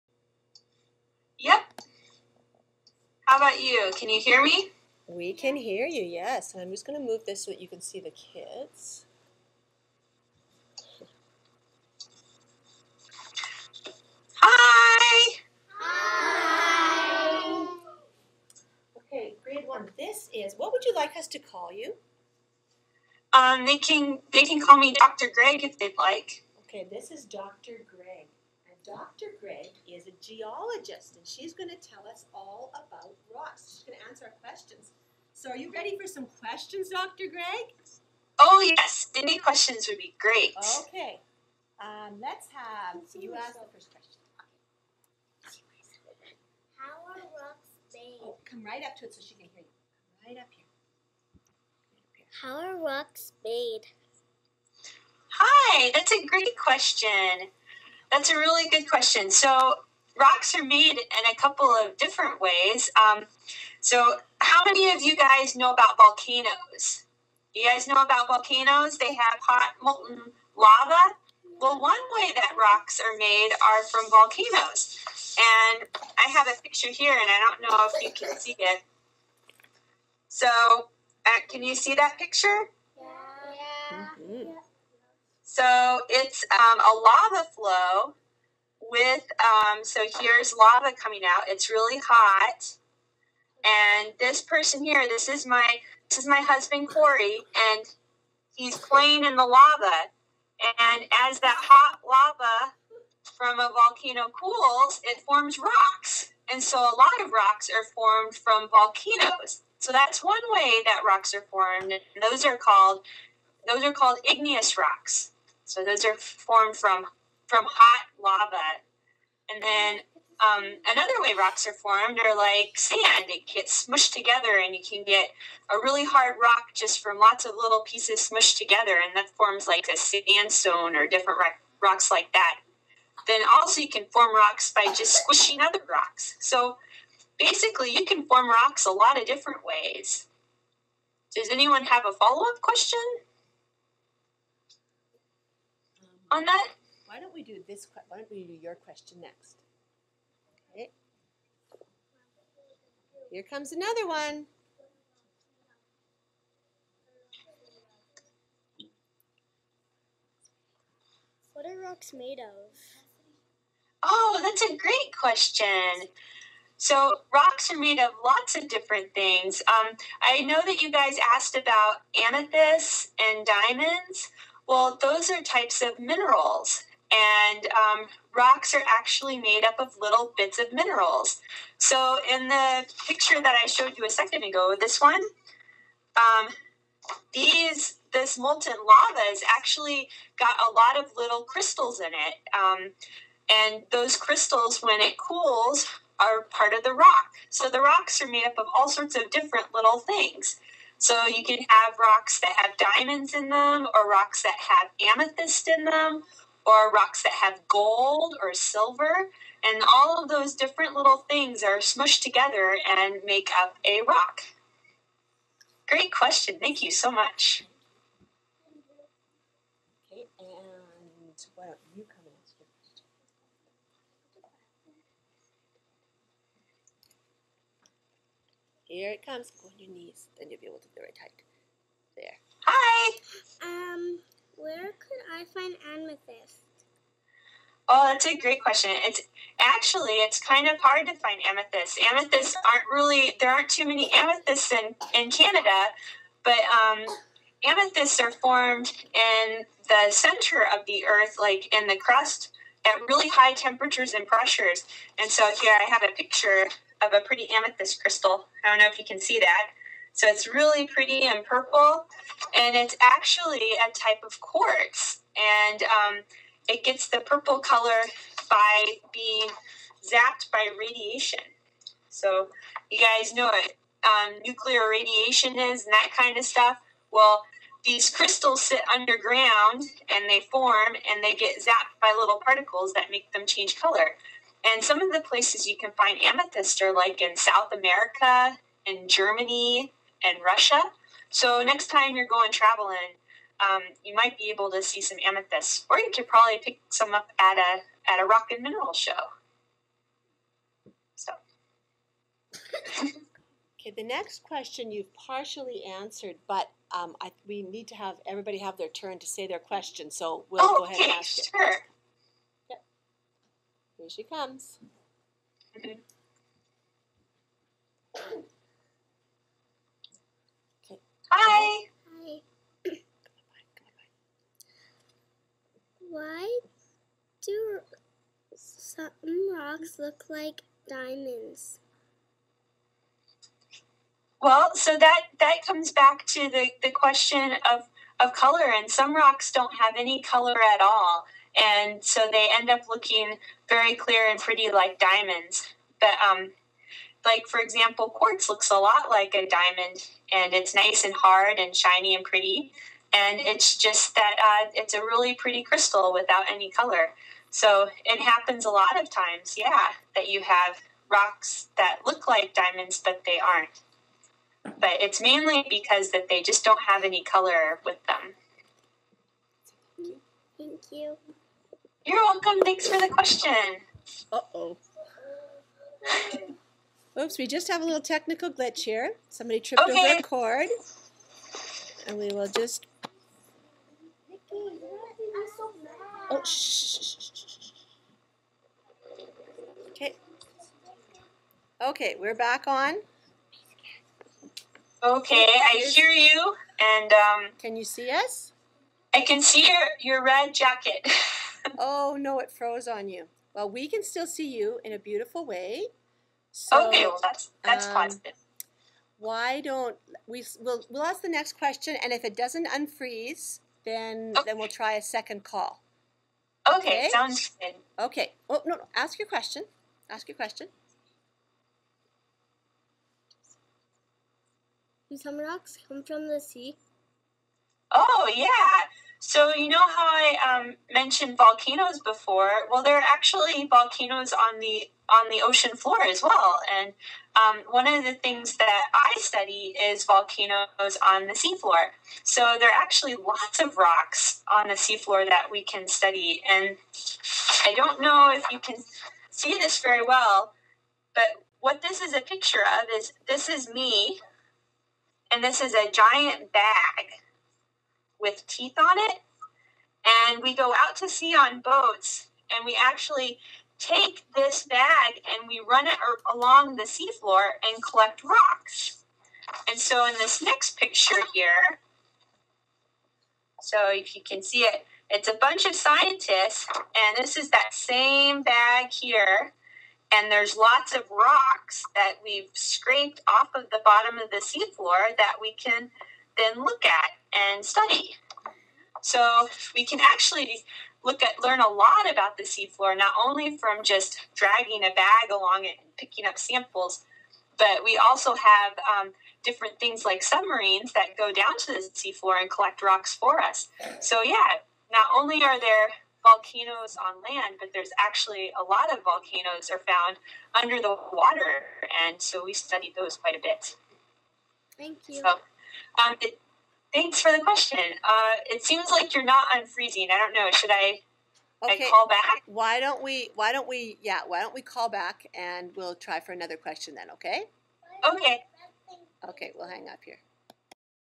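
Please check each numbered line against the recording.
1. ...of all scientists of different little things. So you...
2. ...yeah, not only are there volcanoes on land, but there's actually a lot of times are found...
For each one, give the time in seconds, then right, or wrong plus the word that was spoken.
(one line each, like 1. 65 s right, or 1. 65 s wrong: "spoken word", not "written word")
1. 198 s wrong: "sorts", not "scientists"
2. 504 s wrong: "volcanoes", not "times".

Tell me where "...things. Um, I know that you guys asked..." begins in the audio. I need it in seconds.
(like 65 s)
169 s.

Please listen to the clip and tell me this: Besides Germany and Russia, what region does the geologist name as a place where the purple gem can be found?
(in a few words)
South America.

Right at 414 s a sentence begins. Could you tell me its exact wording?
then we'll try a second call.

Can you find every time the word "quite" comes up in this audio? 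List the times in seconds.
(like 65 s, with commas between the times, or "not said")
513 s.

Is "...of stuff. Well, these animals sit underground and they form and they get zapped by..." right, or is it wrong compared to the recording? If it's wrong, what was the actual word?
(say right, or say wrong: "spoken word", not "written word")
wrong: "crystals", not "animals".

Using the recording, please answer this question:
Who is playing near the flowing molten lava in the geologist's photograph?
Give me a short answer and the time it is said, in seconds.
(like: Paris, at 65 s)
Corey, at 96 s.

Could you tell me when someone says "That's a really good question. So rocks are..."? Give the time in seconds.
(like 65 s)
58 s.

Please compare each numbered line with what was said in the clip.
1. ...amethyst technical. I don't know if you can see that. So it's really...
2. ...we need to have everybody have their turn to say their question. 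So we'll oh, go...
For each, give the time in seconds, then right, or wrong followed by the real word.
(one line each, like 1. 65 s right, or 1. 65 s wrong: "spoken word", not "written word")
1. 257 s wrong: "crystal", not "technical"
2. 307 s right.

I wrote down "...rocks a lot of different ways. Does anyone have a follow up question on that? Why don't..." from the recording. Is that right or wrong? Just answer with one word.
right.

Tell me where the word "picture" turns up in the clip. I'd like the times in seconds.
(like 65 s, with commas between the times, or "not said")
76 s, 82 s, 183 s, 256 s, 452 s, 470 s.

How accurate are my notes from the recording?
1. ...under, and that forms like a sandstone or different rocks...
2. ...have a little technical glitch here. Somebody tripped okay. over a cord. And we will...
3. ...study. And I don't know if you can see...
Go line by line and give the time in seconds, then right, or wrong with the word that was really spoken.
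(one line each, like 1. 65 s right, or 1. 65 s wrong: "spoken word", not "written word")
1. 128 s wrong: "together", not "under"
2. 377 s right
3. 445 s right.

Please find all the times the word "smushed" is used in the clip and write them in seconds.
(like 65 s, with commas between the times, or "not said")
123 s, 128 s, 211 s.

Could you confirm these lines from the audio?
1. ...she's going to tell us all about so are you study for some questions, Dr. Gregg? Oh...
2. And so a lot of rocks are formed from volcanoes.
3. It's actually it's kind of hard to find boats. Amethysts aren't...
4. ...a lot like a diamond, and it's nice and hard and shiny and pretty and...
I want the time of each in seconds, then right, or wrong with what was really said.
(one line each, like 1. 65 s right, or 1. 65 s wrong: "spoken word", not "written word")
1. 31 s wrong: "ready", not "study"
2. 106 s right
3. 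238 s wrong: "amethysts", not "boats"
4. 348 s right.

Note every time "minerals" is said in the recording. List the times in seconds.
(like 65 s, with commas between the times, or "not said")
175 s, 180 s, 298 s.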